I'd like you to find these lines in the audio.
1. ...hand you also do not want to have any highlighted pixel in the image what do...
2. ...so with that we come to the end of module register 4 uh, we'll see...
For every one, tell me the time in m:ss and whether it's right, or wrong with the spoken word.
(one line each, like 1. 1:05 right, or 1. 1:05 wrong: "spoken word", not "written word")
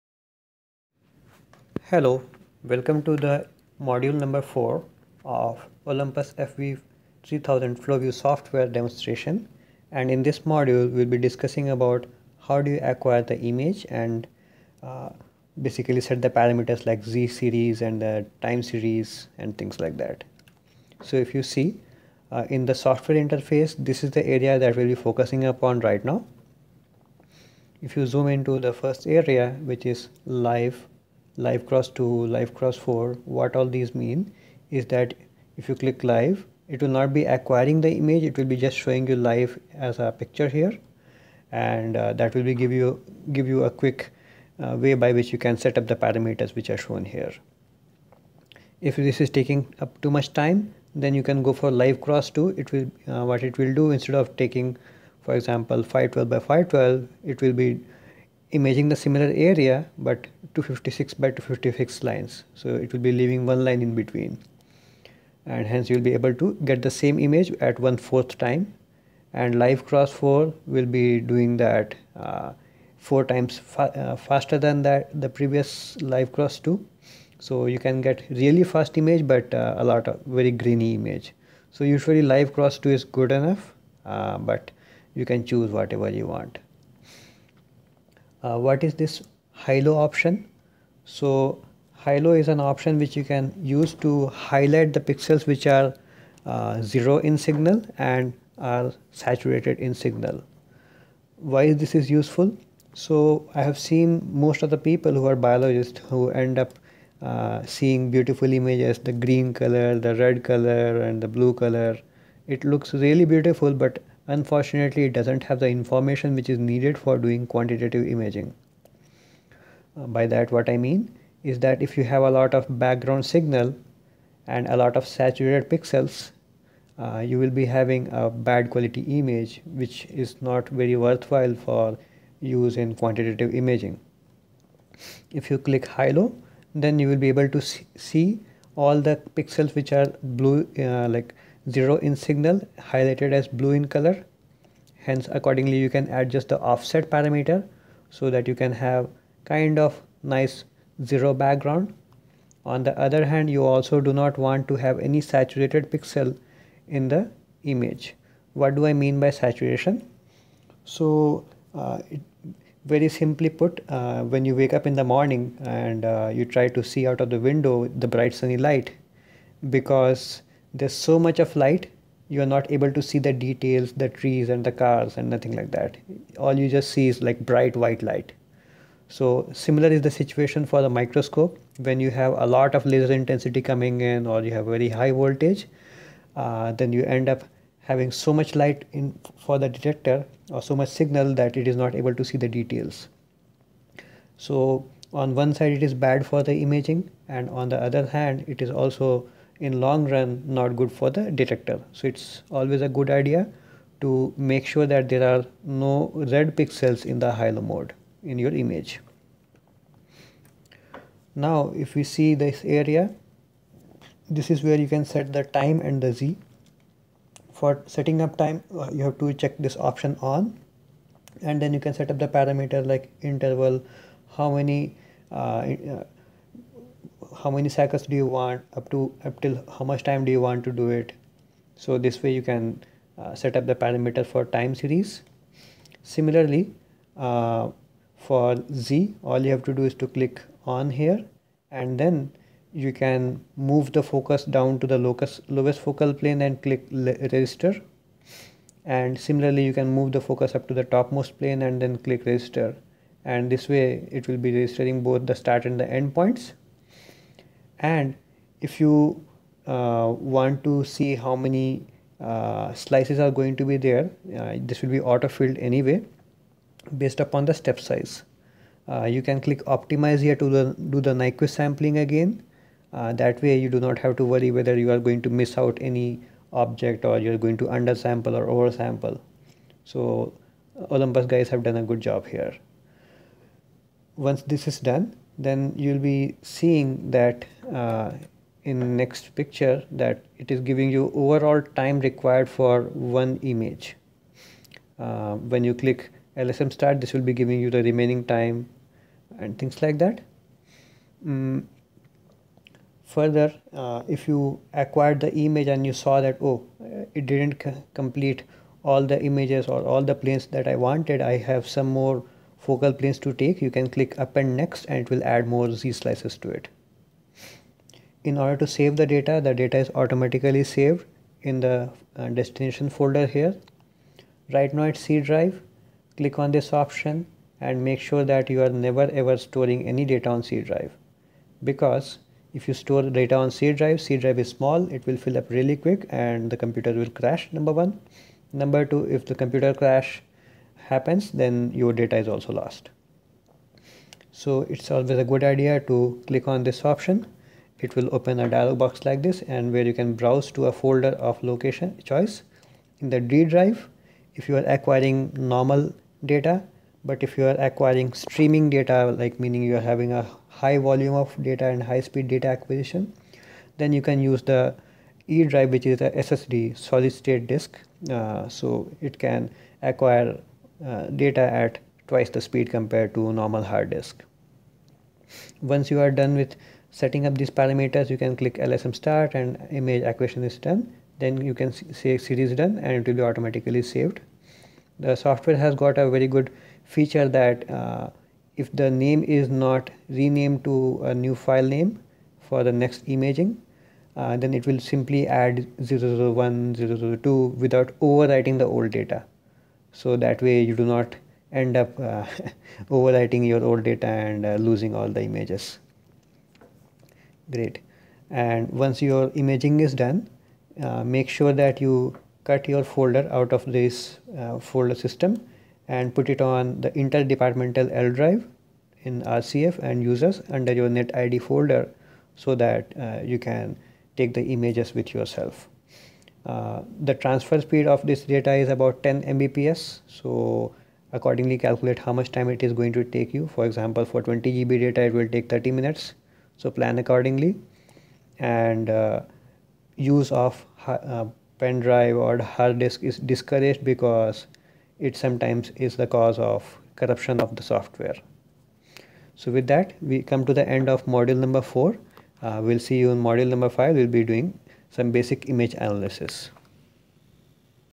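1. 2:33 wrong: "saturated", not "highlighted"
2. 7:29 wrong: "number", not "register".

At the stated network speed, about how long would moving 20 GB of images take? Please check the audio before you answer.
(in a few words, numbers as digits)
30 minutes.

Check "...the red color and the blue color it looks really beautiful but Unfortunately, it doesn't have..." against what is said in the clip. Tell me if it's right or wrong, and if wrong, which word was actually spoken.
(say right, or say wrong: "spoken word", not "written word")
right.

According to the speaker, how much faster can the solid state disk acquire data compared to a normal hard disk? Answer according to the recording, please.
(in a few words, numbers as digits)
twice.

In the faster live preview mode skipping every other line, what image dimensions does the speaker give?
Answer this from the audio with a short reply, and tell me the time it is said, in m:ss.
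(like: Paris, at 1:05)
256 by 256, at 1:00.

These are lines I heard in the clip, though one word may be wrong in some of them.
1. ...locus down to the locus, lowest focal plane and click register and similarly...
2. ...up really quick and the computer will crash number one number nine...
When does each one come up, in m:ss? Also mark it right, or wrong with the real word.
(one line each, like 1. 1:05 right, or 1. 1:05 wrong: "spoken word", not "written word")
1. 4:04 wrong: "focus", not "locus"
2. 5:35 wrong: "two", not "nine".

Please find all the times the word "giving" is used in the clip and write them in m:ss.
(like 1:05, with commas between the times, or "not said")
4:50, 4:57.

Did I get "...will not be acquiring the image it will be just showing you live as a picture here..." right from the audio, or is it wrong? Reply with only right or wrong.
right.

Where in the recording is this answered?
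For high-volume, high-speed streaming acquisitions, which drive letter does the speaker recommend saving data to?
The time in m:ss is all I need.
6:05.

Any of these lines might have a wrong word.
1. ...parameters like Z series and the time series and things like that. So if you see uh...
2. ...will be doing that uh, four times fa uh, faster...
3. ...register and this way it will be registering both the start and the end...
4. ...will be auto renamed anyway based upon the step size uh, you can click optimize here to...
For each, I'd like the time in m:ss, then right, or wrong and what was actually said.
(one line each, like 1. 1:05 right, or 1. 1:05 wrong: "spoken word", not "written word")
1. 0:16 right
2. 1:10 right
3. 4:12 right
4. 4:24 wrong: "filled", not "renamed".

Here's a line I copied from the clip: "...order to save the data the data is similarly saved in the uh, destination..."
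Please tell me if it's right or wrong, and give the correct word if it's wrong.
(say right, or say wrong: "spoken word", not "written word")
wrong: "automatically", not "similarly".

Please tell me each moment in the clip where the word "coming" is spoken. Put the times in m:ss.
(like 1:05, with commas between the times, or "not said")
3:03.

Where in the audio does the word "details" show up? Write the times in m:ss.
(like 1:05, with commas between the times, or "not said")
2:53, 3:12.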